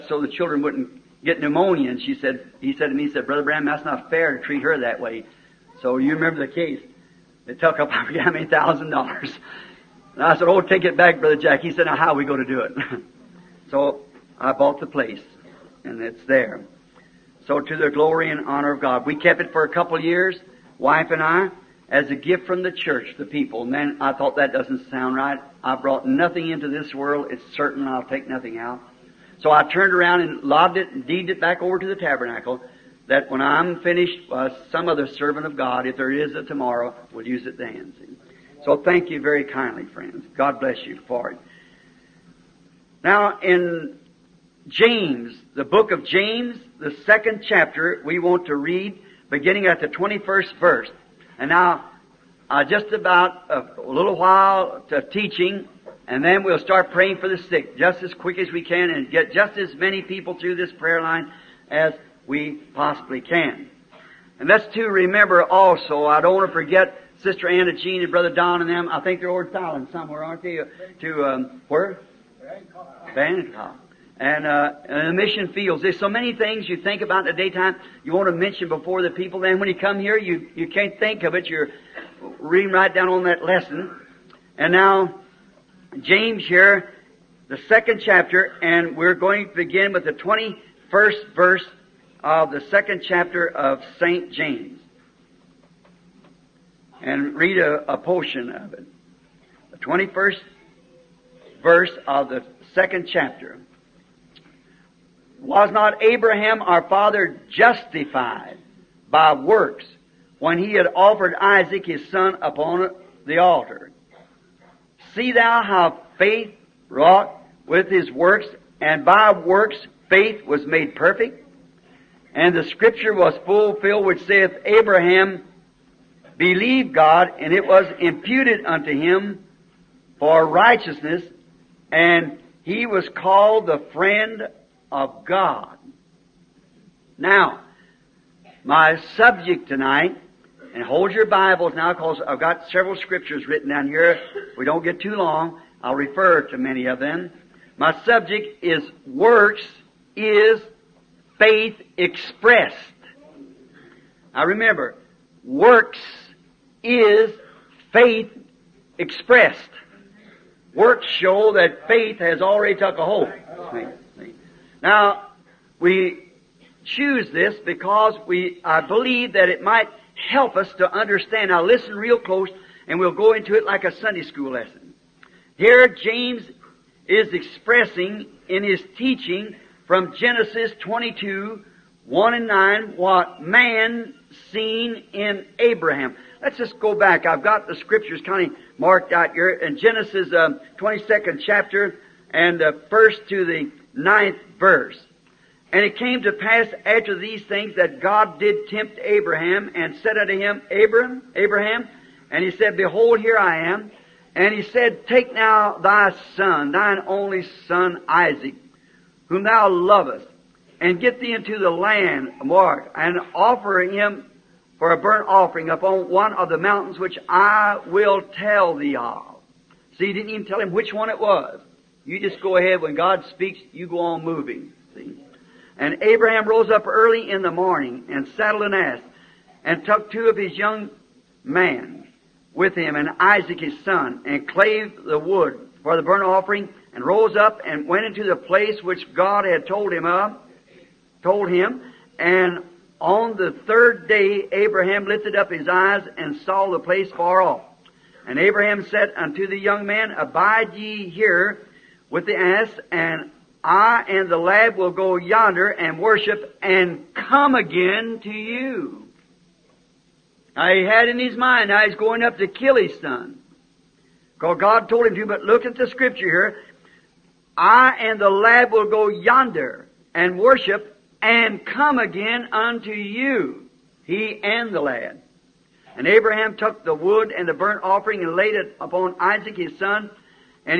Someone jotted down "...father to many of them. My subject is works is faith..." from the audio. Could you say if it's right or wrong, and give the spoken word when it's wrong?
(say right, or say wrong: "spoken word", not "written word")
wrong: "refer", not "father".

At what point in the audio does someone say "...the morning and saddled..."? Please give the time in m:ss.
3:47.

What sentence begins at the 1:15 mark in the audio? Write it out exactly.
There's so many things you think about in the daytime you want to mention before the people.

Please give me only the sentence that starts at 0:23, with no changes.
And then I thought that doesn't sound right.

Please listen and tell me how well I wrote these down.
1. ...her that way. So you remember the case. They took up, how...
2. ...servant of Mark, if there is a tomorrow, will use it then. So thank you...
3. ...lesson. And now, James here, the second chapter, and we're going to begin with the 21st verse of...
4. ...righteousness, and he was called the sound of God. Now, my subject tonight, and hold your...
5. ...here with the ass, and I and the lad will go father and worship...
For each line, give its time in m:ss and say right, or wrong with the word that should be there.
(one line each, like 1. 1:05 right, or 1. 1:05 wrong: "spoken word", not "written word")
1. 0:04 right
2. 0:35 wrong: "God", not "Mark"
3. 1:23 right
4. 2:10 wrong: "friend", not "sound"
5. 4:11 wrong: "yonder", not "father".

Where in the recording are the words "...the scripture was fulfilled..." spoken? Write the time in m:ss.
2:02.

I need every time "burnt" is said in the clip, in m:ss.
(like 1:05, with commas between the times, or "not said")
3:34, 3:56, 4:37.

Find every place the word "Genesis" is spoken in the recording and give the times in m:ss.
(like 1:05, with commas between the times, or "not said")
3:00, 3:09.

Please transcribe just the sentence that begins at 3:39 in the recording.
See, he didn't even tell him which one it was.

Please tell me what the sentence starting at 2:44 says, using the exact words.
Now, we choose this because we, I believe that it might help us to understand.